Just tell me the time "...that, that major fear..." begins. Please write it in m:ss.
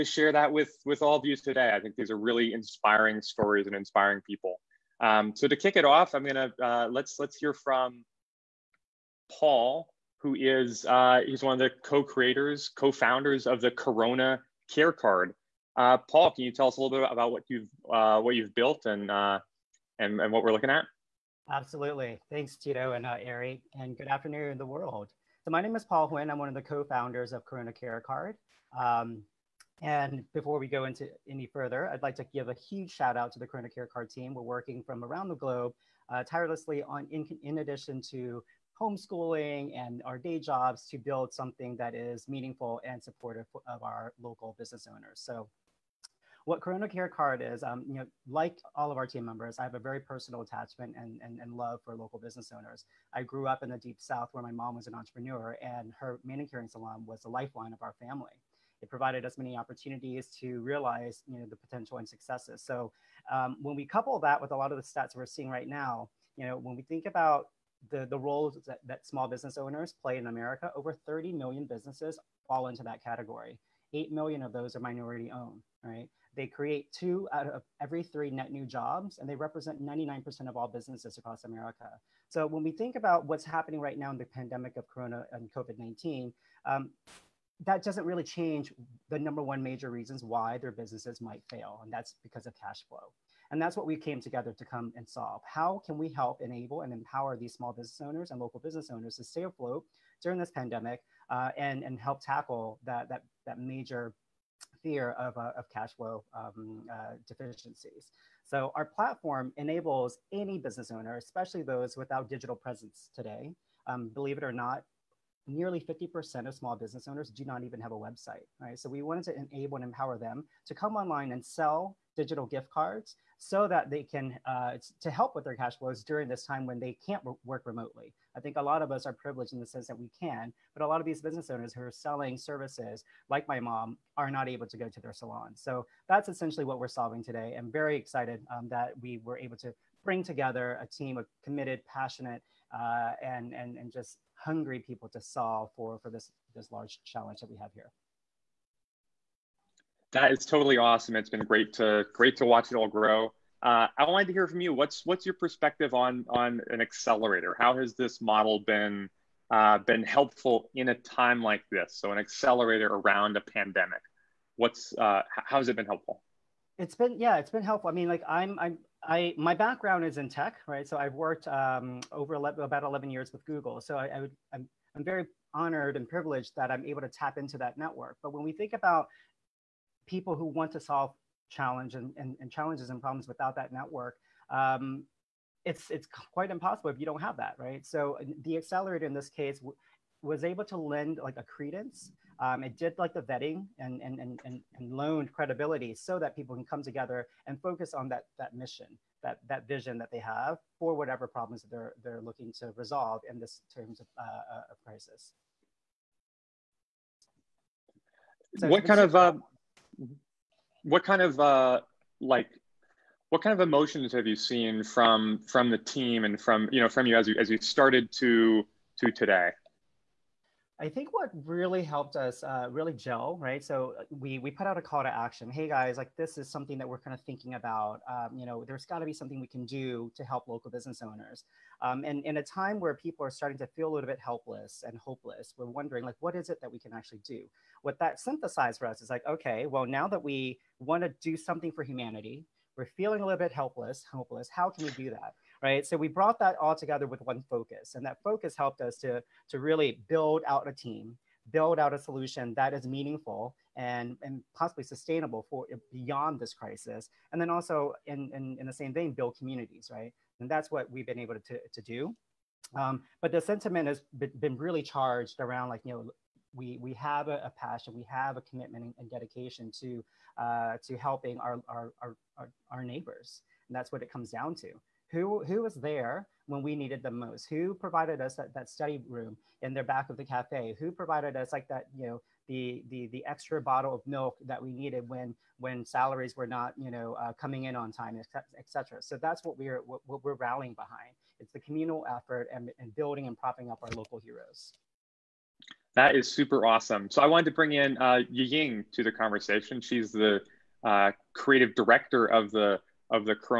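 1:43.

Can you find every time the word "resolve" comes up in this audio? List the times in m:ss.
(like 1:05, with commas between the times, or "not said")
3:22.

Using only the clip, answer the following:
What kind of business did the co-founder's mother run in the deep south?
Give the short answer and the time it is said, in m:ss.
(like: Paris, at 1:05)
manicuring salon, at 0:56.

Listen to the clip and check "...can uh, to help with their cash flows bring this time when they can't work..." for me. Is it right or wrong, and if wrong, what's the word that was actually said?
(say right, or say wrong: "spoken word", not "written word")
wrong: "during", not "bring".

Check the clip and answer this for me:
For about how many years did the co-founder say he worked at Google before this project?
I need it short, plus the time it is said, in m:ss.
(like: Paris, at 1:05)
11, at 2:52.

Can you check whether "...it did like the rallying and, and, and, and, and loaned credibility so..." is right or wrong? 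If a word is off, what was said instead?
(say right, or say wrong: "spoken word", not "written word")
wrong: "vetting", not "rallying".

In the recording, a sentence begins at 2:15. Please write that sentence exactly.
So that's essentially what we're solving today.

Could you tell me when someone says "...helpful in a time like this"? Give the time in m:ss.
2:40.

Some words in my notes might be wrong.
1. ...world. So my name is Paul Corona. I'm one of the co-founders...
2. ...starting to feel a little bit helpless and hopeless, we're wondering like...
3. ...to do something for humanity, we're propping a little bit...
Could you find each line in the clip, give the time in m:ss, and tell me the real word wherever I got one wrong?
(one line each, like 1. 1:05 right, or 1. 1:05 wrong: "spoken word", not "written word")
1. 0:24 wrong: "Huynh", not "Corona"
2. 3:53 right
3. 4:01 wrong: "feeling", not "propping".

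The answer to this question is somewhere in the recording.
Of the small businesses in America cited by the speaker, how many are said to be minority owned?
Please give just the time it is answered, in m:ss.
1:13.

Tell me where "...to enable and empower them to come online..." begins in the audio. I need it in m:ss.
1:59.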